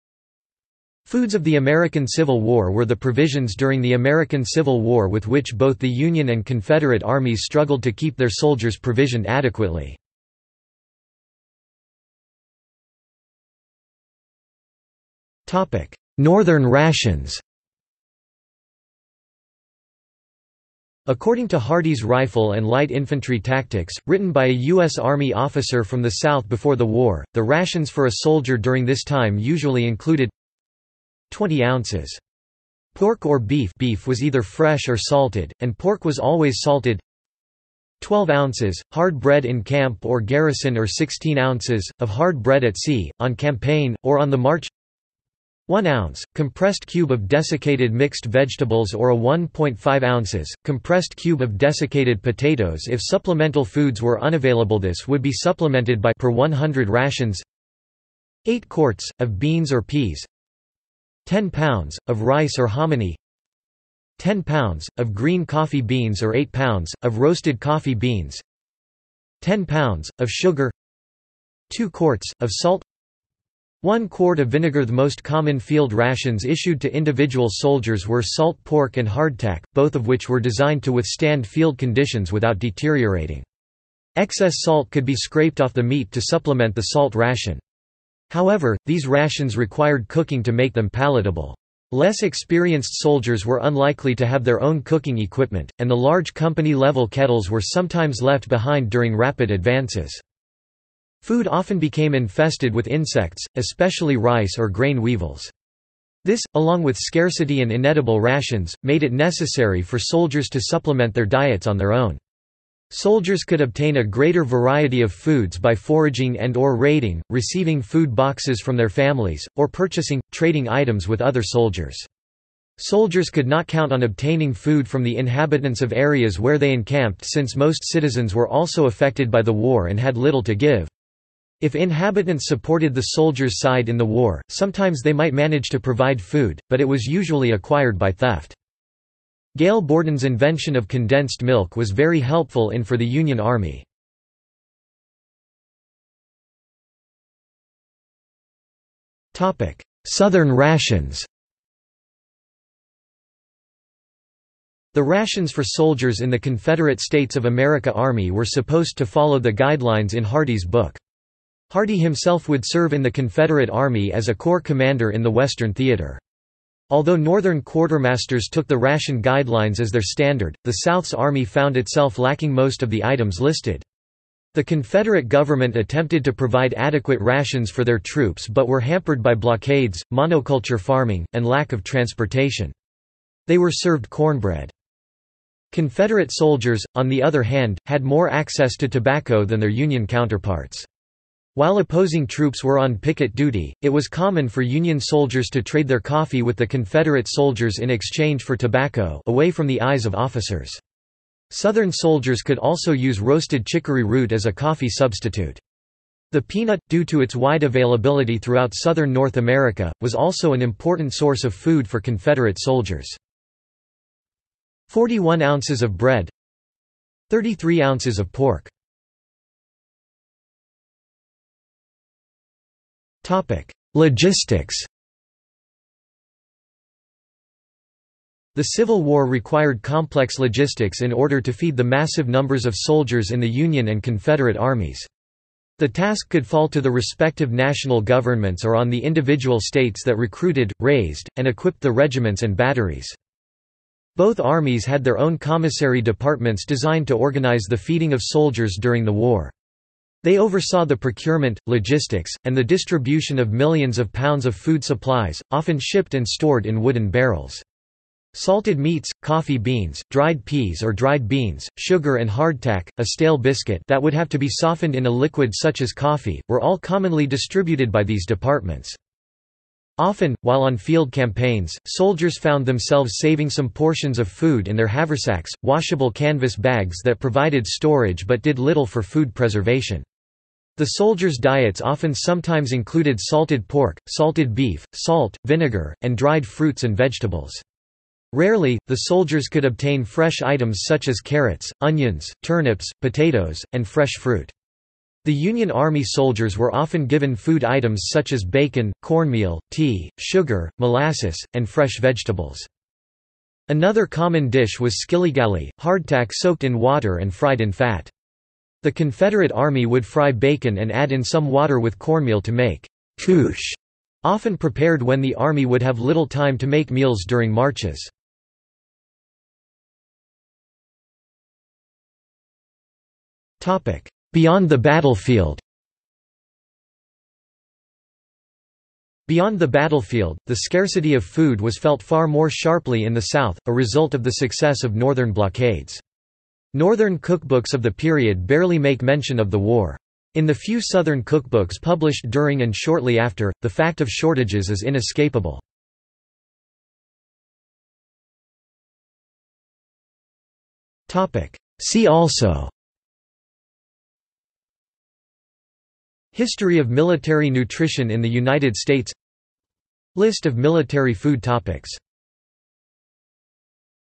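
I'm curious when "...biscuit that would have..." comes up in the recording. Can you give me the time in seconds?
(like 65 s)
263 s.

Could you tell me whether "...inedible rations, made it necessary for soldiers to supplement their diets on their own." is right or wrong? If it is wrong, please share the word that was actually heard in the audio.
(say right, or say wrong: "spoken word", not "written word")
right.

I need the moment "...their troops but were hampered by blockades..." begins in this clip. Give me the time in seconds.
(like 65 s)
177 s.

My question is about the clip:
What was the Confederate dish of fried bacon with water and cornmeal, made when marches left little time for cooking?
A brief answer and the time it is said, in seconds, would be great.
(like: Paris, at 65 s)
couche, at 313 s.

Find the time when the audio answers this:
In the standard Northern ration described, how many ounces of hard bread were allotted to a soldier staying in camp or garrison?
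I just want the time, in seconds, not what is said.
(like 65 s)
38 s.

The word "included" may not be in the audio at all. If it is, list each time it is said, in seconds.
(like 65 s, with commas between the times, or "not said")
29 s, 282 s.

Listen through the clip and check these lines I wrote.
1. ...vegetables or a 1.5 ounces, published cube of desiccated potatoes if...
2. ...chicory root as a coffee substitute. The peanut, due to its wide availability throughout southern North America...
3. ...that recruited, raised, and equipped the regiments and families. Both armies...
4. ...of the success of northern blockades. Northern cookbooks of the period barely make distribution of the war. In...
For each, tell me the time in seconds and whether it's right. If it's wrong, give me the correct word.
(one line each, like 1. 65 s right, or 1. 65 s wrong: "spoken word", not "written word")
1. 48 s wrong: "compressed", not "published"
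2. 203 s right
3. 240 s wrong: "batteries", not "families"
4. 334 s wrong: "mention", not "distribution".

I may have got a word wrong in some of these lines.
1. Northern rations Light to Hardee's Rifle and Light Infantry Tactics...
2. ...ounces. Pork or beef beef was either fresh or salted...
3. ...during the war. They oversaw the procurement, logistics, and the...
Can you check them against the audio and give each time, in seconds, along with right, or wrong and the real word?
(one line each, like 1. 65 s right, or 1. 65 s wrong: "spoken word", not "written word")
1. 16 s wrong: "According", not "Light"
2. 31 s right
3. 248 s right.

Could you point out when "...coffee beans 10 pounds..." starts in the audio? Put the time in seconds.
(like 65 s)
67 s.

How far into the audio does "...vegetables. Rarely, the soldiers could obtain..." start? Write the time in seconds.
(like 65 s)
286 s.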